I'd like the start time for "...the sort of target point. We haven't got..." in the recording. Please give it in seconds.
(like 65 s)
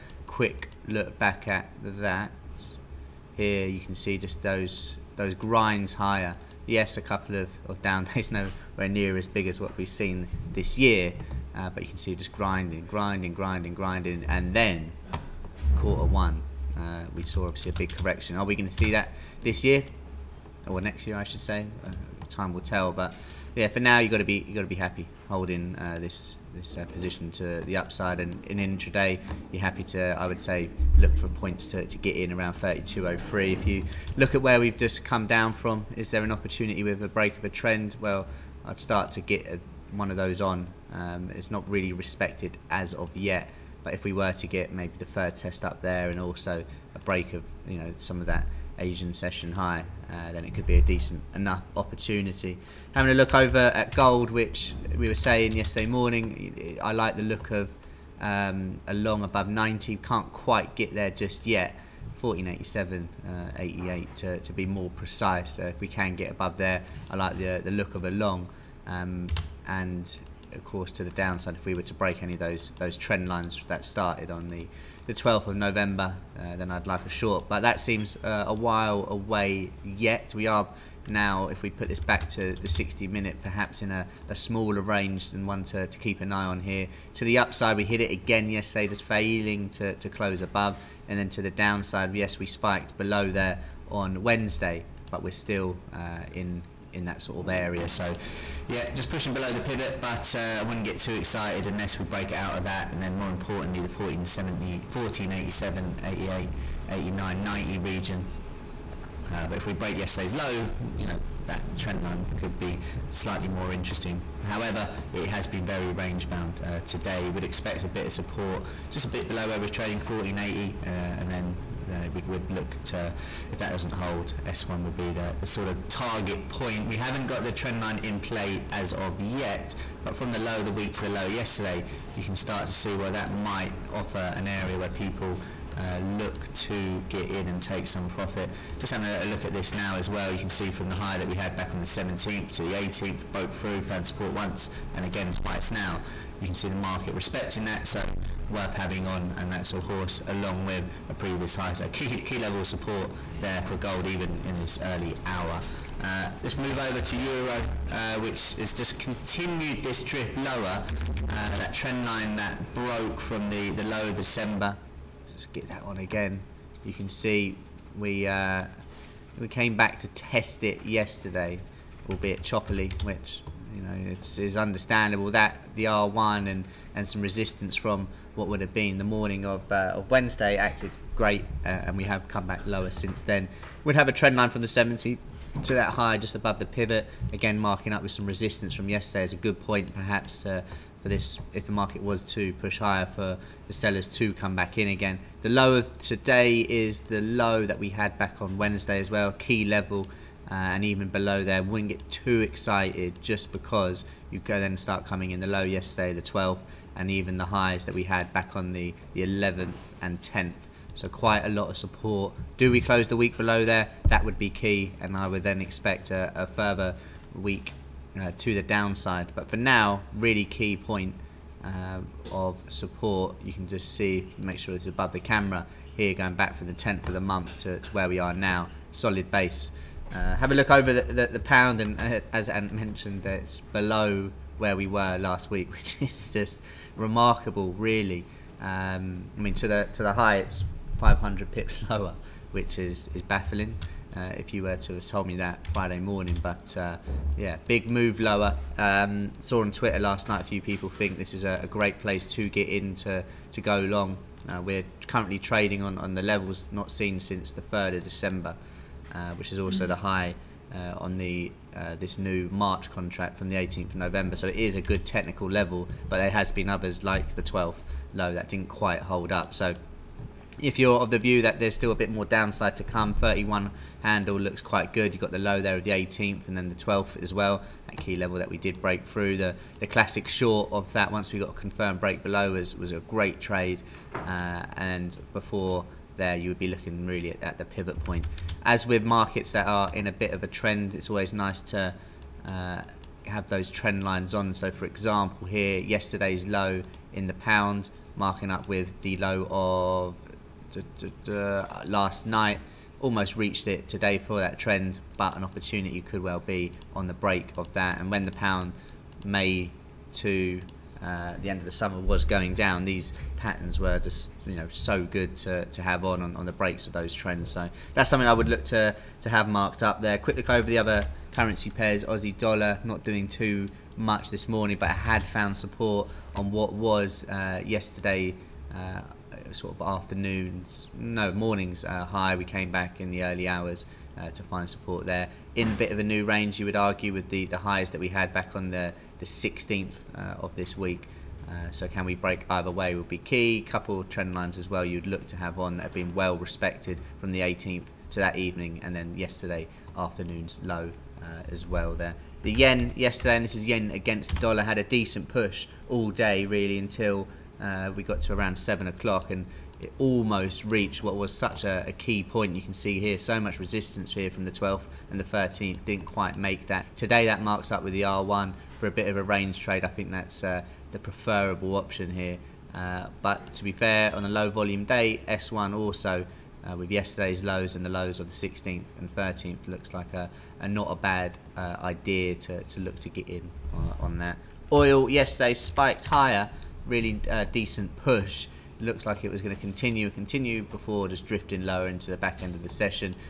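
125 s.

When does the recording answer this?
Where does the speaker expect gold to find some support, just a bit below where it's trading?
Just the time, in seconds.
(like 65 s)
119 s.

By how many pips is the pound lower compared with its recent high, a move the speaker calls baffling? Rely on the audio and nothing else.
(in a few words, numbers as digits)
500.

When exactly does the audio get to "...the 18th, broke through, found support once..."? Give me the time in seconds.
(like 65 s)
142 s.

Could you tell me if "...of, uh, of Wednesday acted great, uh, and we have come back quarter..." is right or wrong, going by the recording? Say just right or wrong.
wrong.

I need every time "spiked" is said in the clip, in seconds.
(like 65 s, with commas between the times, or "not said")
92 s, 385 s.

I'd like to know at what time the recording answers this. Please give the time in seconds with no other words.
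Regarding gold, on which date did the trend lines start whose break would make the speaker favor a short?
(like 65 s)
75 s.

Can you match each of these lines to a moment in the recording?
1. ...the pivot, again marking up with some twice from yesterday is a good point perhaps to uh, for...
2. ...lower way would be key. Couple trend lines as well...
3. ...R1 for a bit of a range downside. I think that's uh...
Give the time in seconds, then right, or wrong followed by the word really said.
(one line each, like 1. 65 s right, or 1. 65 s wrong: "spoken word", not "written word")
1. 186 s wrong: "resistance", not "twice"
2. 342 s wrong: "either", not "lower"
3. 368 s wrong: "trade", not "downside".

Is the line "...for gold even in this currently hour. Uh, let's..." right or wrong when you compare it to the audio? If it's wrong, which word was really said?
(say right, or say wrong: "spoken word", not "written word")
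wrong: "early", not "currently".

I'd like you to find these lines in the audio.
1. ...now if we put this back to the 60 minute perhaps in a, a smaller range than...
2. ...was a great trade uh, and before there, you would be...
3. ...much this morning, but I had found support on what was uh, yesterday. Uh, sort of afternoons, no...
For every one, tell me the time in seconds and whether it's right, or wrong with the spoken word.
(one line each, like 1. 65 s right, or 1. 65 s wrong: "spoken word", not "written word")
1. 81 s right
2. 282 s right
3. 323 s right.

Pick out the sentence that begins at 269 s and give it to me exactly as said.
So if you're of the view that there's still a bit more downside to come, 31 handle looks quite good.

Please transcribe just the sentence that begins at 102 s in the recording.
And then more importantly, the 1470, 1487, 88, 89, 90 region.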